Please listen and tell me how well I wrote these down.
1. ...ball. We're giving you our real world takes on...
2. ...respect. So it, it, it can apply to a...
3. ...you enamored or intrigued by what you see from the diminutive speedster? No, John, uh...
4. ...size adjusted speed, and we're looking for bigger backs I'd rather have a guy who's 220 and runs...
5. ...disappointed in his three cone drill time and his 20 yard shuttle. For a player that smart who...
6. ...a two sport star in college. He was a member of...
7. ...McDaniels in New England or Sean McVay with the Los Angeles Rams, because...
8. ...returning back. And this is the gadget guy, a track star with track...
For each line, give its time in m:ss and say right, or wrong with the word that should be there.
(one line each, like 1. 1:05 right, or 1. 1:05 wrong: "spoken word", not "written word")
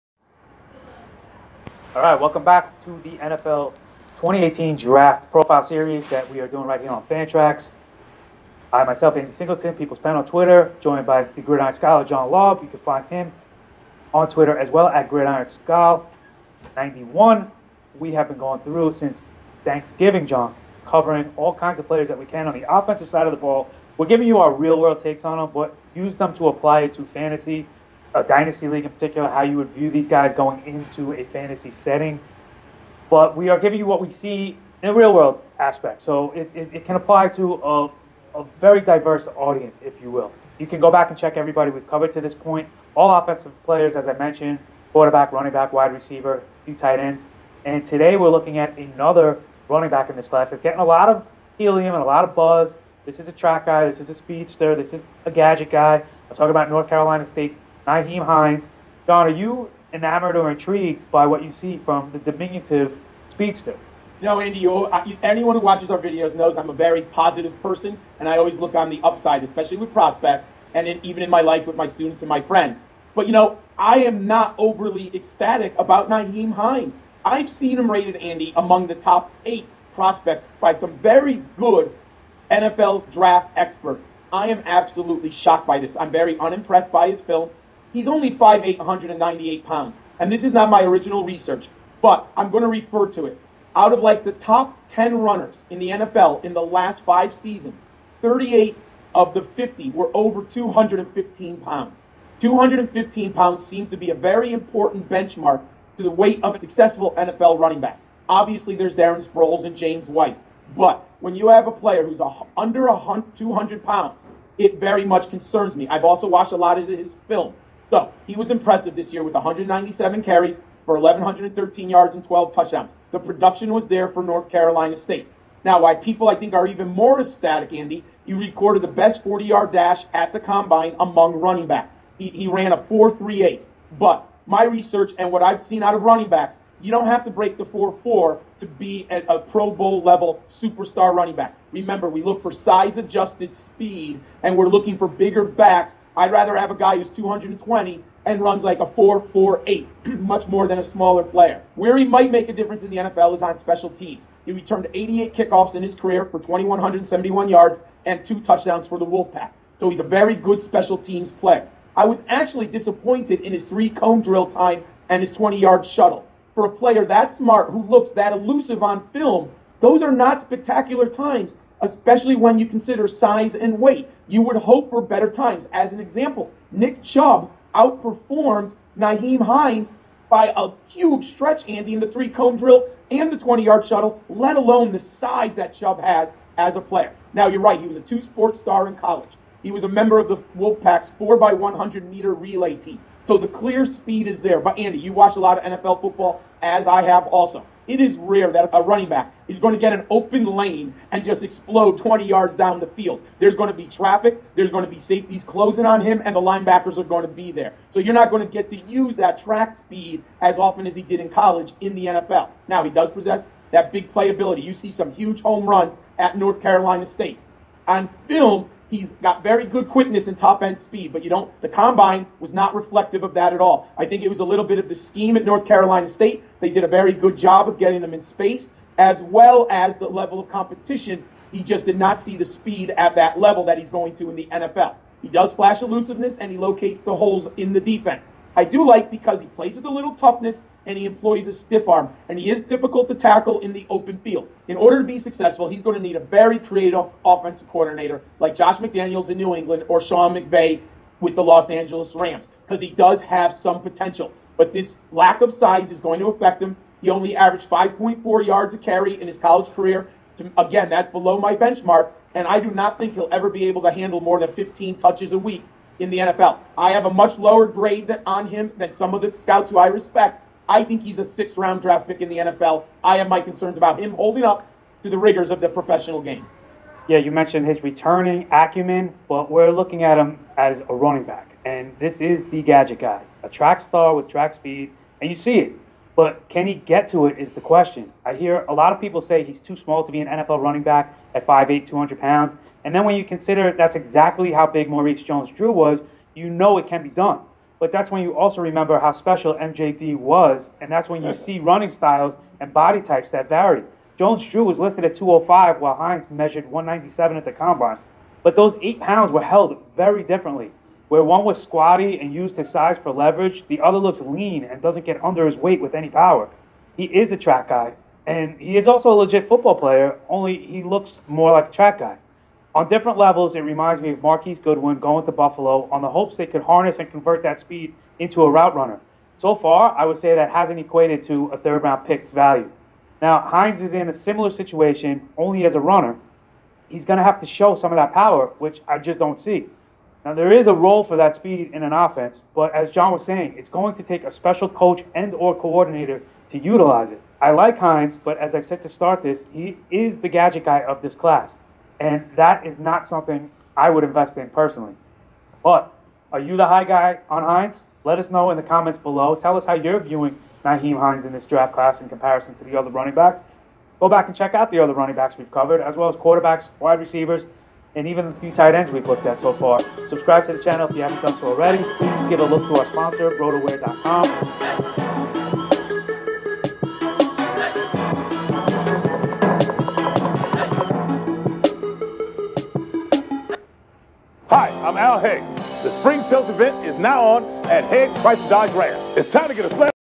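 1. 0:23 right
2. 0:35 wrong: "aspect", not "respect"
3. 0:59 wrong: "Andy", not "John"
4. 2:22 right
5. 2:42 right
6. 3:07 right
7. 4:08 right
8. 4:40 wrong: "running", not "returning".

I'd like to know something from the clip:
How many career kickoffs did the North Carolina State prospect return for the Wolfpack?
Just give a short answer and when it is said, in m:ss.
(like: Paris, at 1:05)
88, at 2:34.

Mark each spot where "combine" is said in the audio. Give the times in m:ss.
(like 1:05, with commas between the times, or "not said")
2:10, 3:41, 5:07.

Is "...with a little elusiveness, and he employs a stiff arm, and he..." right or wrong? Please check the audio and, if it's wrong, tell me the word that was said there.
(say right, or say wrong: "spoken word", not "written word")
wrong: "toughness", not "elusiveness".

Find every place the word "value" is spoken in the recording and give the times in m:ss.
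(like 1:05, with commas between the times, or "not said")
5:32.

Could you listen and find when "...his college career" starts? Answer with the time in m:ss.
4:19.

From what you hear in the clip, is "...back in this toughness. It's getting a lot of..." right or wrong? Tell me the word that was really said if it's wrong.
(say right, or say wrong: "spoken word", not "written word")
wrong: "class", not "toughness".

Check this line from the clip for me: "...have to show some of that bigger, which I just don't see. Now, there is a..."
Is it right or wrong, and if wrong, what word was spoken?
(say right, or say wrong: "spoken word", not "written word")
wrong: "power", not "bigger".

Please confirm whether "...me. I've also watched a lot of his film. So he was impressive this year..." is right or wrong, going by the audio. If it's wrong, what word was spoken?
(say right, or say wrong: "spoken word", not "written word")
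right.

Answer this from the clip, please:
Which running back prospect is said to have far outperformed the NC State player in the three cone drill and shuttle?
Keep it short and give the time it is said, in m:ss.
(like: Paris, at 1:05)
Nick Chubb, at 2:56.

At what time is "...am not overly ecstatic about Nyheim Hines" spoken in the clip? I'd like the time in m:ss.
1:14.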